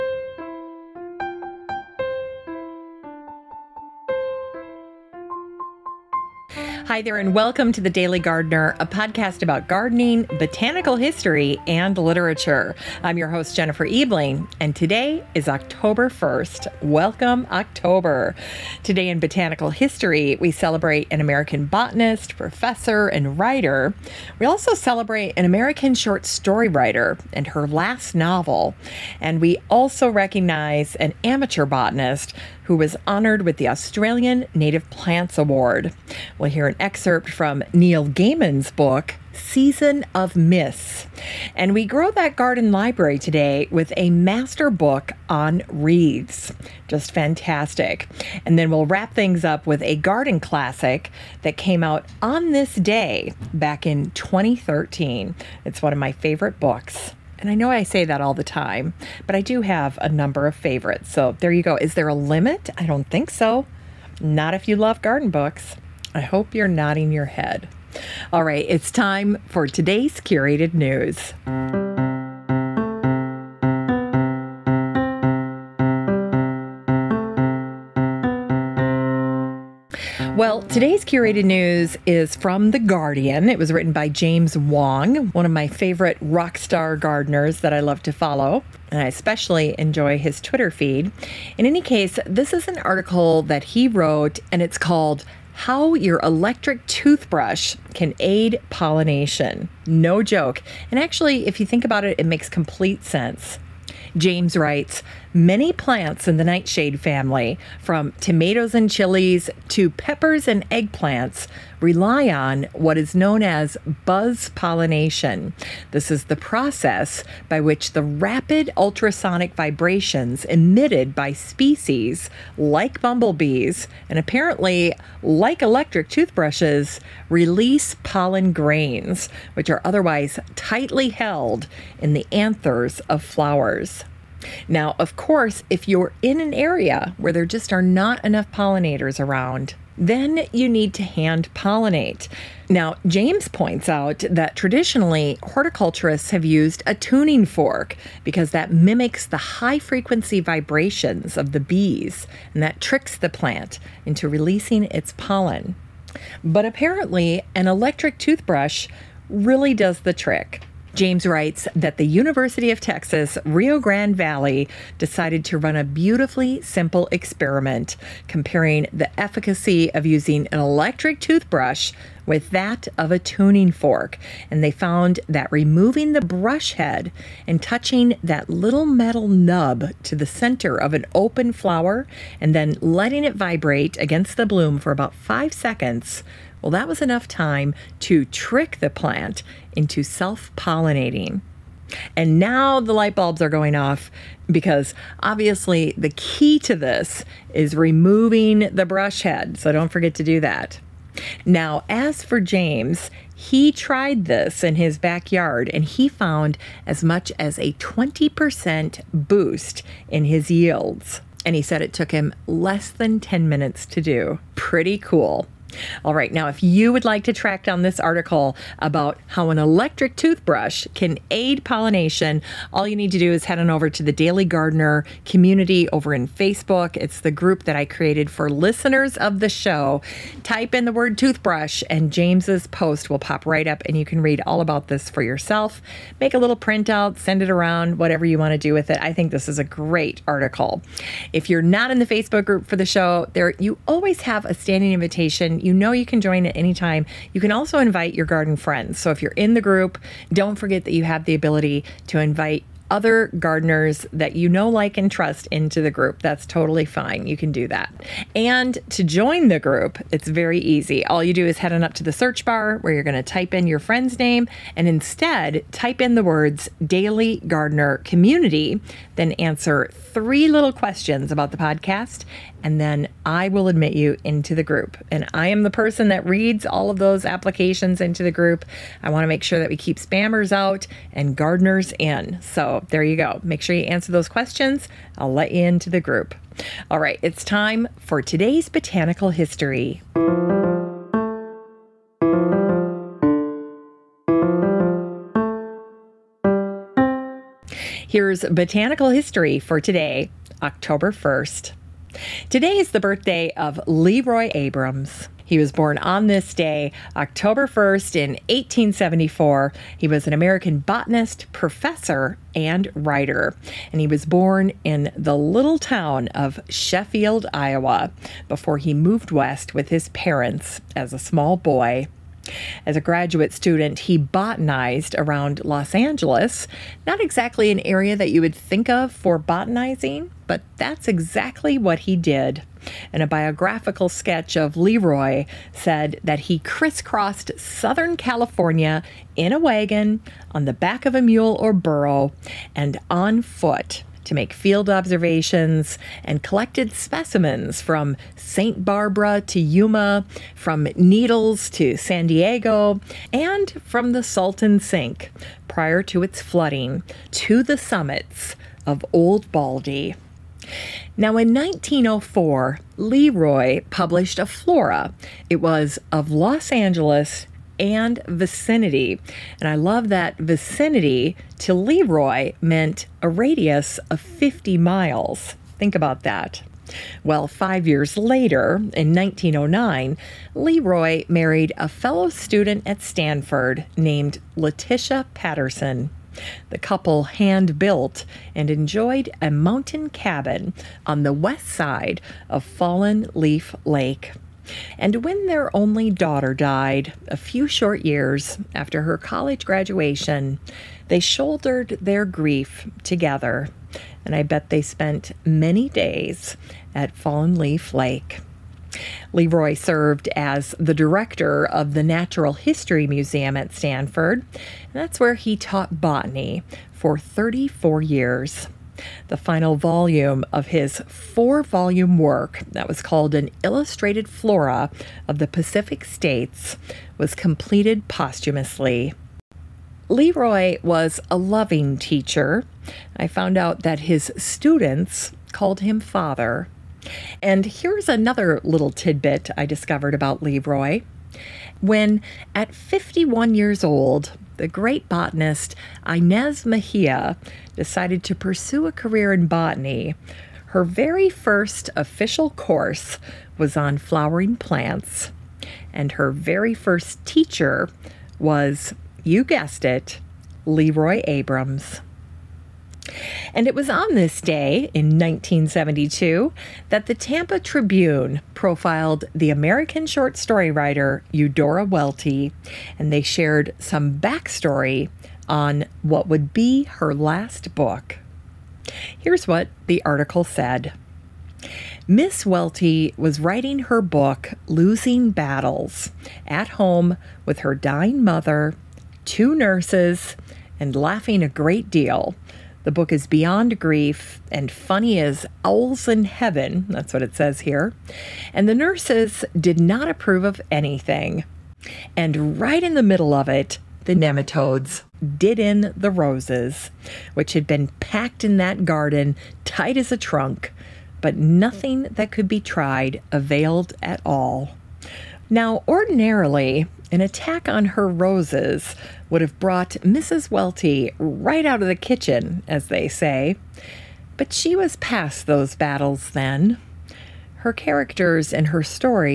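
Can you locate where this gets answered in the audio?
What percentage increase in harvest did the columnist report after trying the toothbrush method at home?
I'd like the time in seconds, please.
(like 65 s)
207 s.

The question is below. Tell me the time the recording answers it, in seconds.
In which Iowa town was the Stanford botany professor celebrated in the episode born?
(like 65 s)
316 s.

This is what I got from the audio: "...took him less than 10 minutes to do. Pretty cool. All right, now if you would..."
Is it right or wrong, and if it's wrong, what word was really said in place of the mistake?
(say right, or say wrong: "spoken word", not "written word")
right.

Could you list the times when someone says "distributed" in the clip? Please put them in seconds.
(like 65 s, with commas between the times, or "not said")
not said.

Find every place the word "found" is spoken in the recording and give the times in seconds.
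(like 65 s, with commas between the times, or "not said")
174 s, 206 s, 433 s.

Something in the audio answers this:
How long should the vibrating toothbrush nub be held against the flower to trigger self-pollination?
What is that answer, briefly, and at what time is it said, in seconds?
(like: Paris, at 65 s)
5 seconds, at 184 s.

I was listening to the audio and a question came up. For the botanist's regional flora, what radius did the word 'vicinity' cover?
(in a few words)
50 miles.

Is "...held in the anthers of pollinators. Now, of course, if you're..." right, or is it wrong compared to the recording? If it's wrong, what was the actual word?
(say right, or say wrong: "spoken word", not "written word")
wrong: "flowers", not "pollinators".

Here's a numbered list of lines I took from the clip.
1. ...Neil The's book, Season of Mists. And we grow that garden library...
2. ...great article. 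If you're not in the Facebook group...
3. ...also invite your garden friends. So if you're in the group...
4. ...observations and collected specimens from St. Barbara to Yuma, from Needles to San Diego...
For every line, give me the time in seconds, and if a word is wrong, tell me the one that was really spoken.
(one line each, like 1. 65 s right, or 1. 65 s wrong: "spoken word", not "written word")
1. 37 s wrong: "Gaiman", not "The"
2. 239 s right
3. 247 s right
4. 344 s right.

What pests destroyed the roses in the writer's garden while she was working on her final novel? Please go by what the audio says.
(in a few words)
Nematodes.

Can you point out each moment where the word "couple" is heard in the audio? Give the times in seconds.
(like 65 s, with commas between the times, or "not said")
386 s.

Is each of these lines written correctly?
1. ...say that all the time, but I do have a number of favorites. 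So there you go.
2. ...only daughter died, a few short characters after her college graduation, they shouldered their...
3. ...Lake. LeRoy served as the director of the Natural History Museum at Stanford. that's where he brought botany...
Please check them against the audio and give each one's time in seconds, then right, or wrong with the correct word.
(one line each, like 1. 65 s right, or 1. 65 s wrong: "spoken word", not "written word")
1. 57 s right
2. 395 s wrong: "years", not "characters"
3. 407 s wrong: "taught", not "brought".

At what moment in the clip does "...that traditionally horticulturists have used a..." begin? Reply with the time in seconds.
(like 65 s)
144 s.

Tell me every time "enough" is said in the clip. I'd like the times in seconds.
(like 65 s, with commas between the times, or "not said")
138 s, 187 s.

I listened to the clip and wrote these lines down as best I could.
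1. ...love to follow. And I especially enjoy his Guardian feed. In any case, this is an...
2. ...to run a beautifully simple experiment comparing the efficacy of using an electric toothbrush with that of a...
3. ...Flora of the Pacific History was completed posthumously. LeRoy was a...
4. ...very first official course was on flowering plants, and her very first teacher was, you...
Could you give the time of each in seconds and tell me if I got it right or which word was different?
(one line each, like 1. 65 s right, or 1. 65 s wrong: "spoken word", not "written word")
1. 87 s wrong: "Twitter", not "Guardian"
2. 165 s right
3. 424 s wrong: "States", not "History"
4. 450 s right.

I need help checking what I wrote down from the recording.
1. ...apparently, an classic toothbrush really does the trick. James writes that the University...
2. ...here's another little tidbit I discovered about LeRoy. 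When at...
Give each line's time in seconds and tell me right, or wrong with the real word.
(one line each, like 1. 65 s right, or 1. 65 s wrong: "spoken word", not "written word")
1. 156 s wrong: "electric", not "classic"
2. 437 s right.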